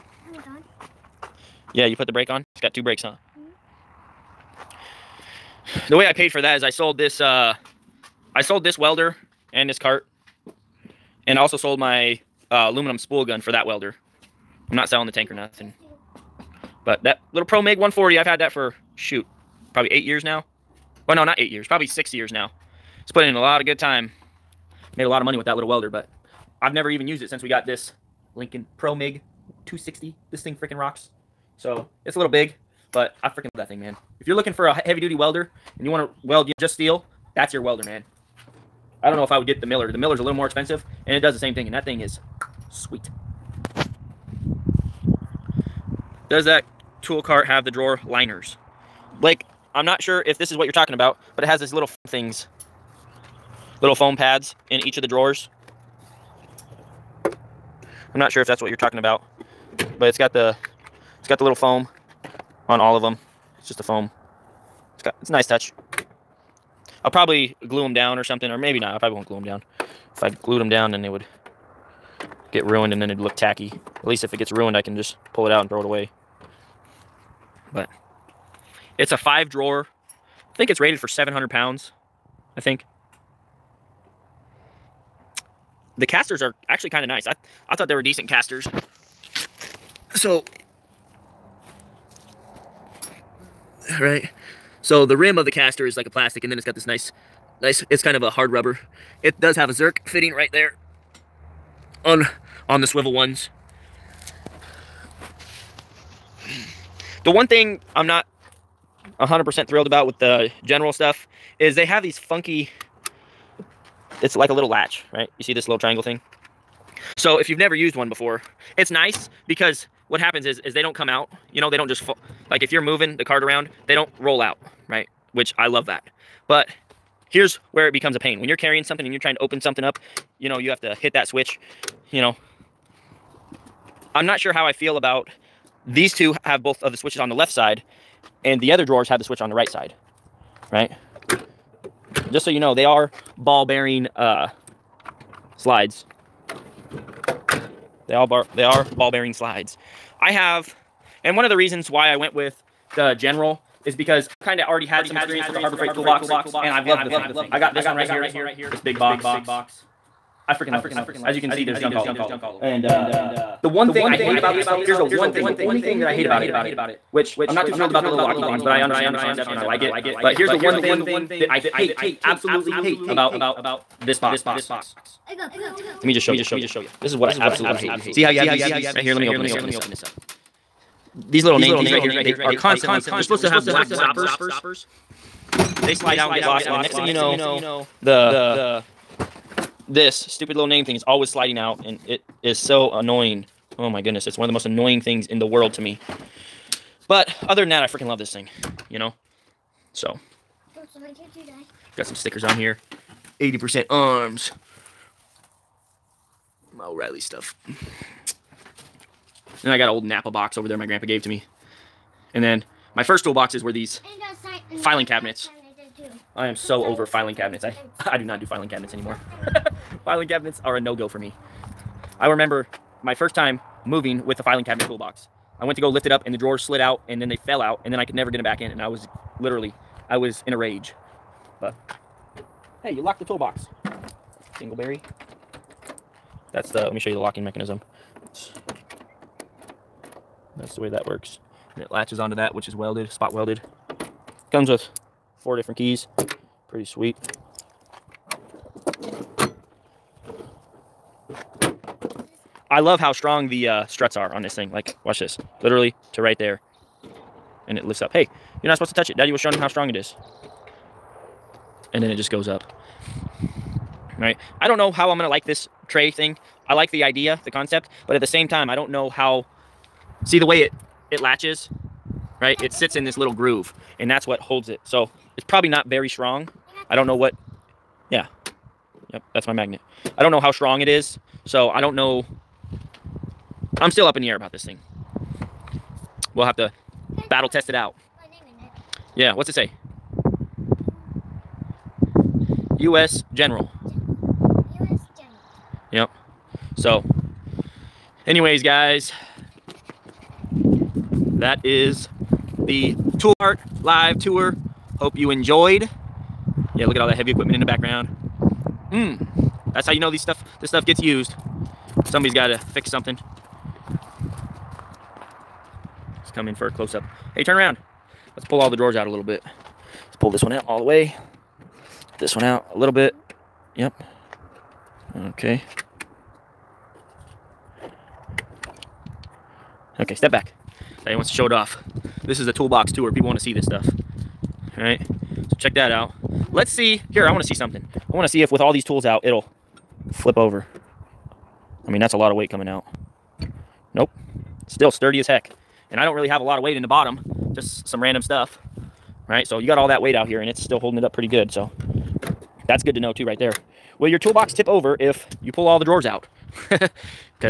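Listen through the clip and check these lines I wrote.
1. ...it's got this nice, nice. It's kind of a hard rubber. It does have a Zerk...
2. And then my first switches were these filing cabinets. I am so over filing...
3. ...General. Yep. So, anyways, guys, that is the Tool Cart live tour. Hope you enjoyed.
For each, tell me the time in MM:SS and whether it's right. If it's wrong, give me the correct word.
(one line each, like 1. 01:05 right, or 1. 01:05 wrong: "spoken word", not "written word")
1. 01:36 right
2. 03:32 wrong: "toolboxes", not "switches"
3. 04:55 right.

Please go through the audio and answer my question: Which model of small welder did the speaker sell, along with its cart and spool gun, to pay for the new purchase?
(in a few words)
Pro MIG 140.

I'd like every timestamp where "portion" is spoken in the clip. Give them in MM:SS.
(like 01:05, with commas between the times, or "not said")
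not said.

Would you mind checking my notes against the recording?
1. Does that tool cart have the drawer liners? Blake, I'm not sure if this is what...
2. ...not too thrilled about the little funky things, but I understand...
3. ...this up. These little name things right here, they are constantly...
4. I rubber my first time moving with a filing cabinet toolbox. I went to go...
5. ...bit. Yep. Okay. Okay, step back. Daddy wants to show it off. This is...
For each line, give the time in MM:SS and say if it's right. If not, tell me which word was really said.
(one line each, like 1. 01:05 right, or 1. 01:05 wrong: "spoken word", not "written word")
1. 00:46 right
2. 02:47 wrong: "locky", not "funky"
3. 02:59 right
4. 03:42 wrong: "remember", not "rubber"
5. 05:22 right.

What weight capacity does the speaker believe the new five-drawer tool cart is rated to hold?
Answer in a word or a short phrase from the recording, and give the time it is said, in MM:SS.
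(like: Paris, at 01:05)
700 pounds, at 01:21.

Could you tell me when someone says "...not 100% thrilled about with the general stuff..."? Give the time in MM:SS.
01:48.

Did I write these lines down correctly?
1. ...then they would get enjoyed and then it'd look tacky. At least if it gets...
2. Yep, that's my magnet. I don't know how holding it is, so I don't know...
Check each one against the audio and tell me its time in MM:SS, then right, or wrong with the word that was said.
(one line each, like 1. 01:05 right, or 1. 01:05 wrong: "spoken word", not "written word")
1. 01:10 wrong: "ruined", not "enjoyed"
2. 04:39 wrong: "strong", not "holding".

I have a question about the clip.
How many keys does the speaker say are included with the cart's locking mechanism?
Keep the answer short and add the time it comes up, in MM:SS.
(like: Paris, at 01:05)
4, at 04:05.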